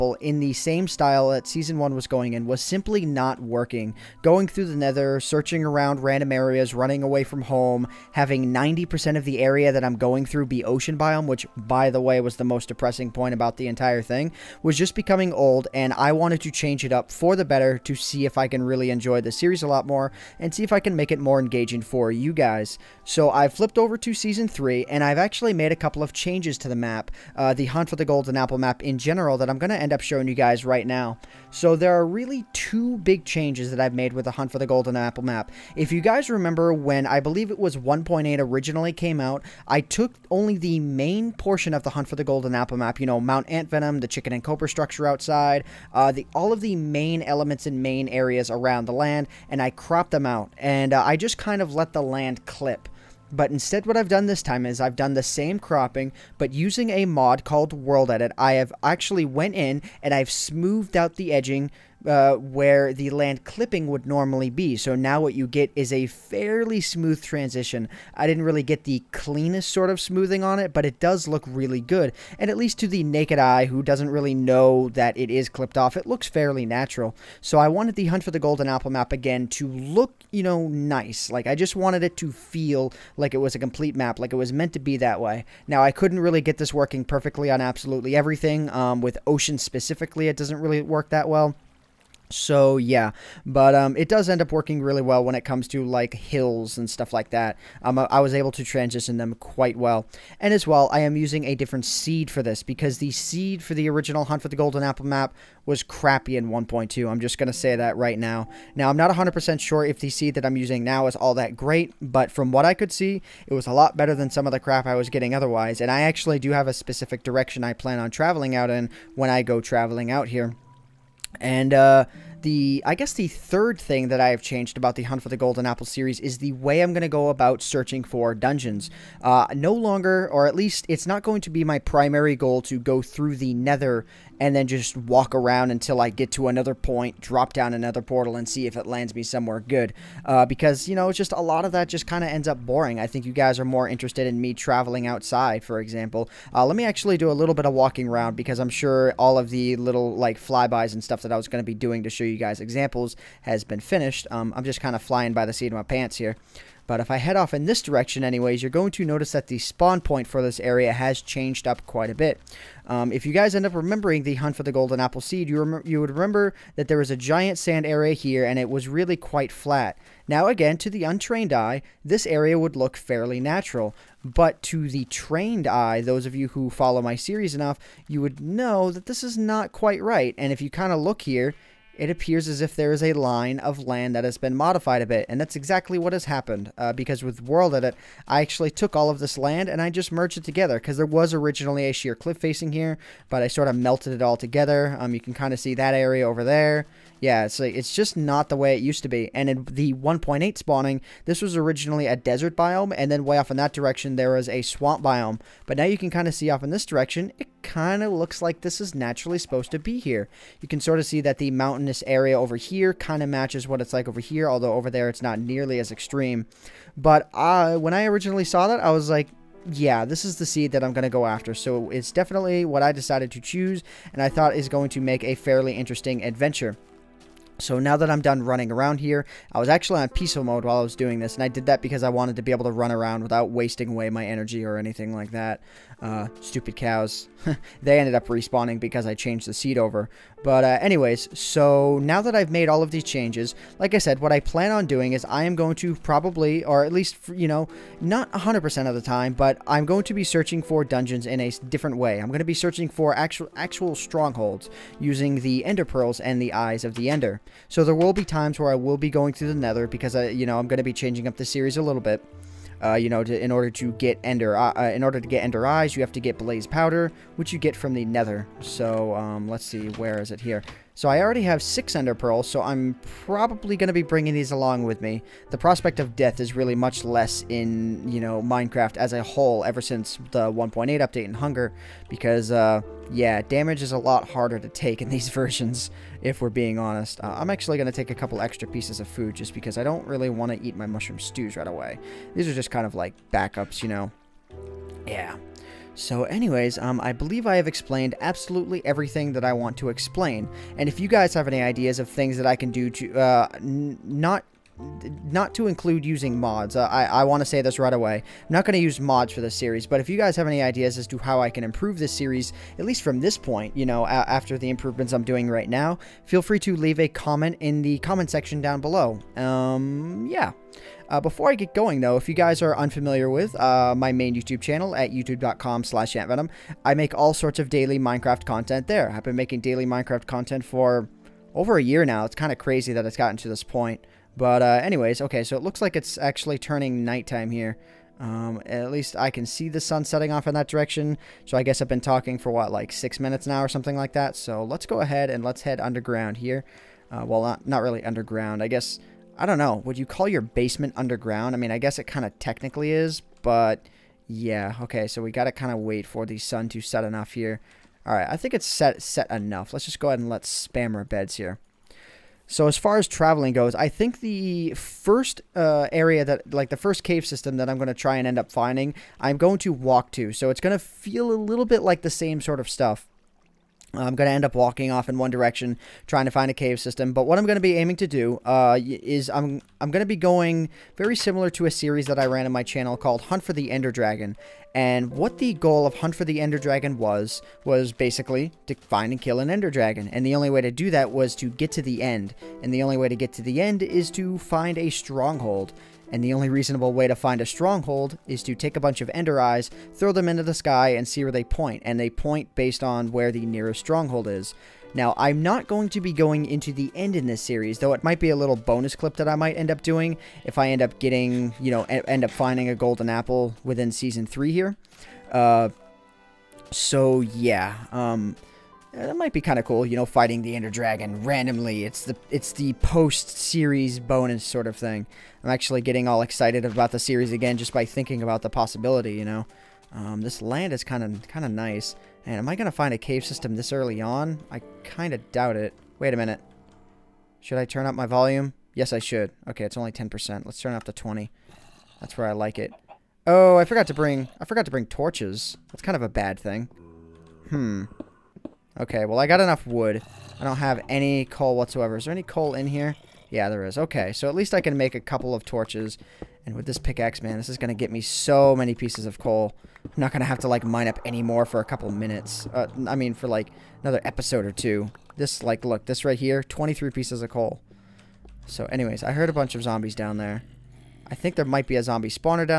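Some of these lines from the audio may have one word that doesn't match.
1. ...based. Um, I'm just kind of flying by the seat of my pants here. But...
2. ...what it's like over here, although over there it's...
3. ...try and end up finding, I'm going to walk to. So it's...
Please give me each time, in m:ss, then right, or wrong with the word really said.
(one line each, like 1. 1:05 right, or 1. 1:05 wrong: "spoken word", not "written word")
1. 2:33 wrong: "finished", not "based"
2. 3:33 right
3. 6:07 right.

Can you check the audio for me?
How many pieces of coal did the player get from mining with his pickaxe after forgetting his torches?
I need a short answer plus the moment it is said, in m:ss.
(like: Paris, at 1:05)
23, at 7:46.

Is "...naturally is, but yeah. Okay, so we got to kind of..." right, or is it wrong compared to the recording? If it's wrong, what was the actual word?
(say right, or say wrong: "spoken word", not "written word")
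wrong: "technically", not "naturally".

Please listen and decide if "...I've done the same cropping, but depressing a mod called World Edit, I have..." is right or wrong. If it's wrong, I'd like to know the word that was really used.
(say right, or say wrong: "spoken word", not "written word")
wrong: "using", not "depressing".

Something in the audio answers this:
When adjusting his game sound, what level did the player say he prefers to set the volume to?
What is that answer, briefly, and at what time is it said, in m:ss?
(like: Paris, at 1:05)
20, at 7:20.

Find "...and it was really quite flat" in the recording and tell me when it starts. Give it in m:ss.
2:48.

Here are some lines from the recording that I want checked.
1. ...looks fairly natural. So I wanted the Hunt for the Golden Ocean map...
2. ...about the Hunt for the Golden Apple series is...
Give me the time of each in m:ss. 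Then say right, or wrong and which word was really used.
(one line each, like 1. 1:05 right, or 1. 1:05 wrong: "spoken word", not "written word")
1. 1:16 wrong: "Apple", not "Ocean"
2. 2:04 right.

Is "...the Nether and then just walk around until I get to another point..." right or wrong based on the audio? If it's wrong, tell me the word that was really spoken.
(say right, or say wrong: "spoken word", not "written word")
right.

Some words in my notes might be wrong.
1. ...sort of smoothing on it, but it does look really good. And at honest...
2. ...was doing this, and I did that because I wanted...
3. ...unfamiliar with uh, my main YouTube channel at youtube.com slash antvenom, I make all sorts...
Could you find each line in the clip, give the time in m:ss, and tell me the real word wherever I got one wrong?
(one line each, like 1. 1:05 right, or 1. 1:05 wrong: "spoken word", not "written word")
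1. 1:09 wrong: "least", not "honest"
2. 3:50 right
3. 5:22 right.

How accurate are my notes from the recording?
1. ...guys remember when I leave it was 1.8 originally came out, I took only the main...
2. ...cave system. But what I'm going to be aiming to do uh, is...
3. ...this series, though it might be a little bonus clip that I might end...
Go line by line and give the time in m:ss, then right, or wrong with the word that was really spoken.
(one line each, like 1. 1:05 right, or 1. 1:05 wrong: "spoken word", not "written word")
1. 0:36 wrong: "believe", not "leave"
2. 6:16 right
3. 6:47 right.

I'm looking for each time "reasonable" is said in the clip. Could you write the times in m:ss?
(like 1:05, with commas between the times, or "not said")
6:36.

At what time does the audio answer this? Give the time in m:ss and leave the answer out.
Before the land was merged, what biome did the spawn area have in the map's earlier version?
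3:22.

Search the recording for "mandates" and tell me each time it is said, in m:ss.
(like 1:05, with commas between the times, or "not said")
not said.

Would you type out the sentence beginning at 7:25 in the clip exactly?
That's kind of a bad thing.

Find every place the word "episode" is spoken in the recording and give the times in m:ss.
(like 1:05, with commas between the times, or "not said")
7:44.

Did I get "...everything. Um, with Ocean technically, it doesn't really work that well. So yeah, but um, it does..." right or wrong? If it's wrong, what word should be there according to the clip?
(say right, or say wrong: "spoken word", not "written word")
wrong: "specifically", not "technically".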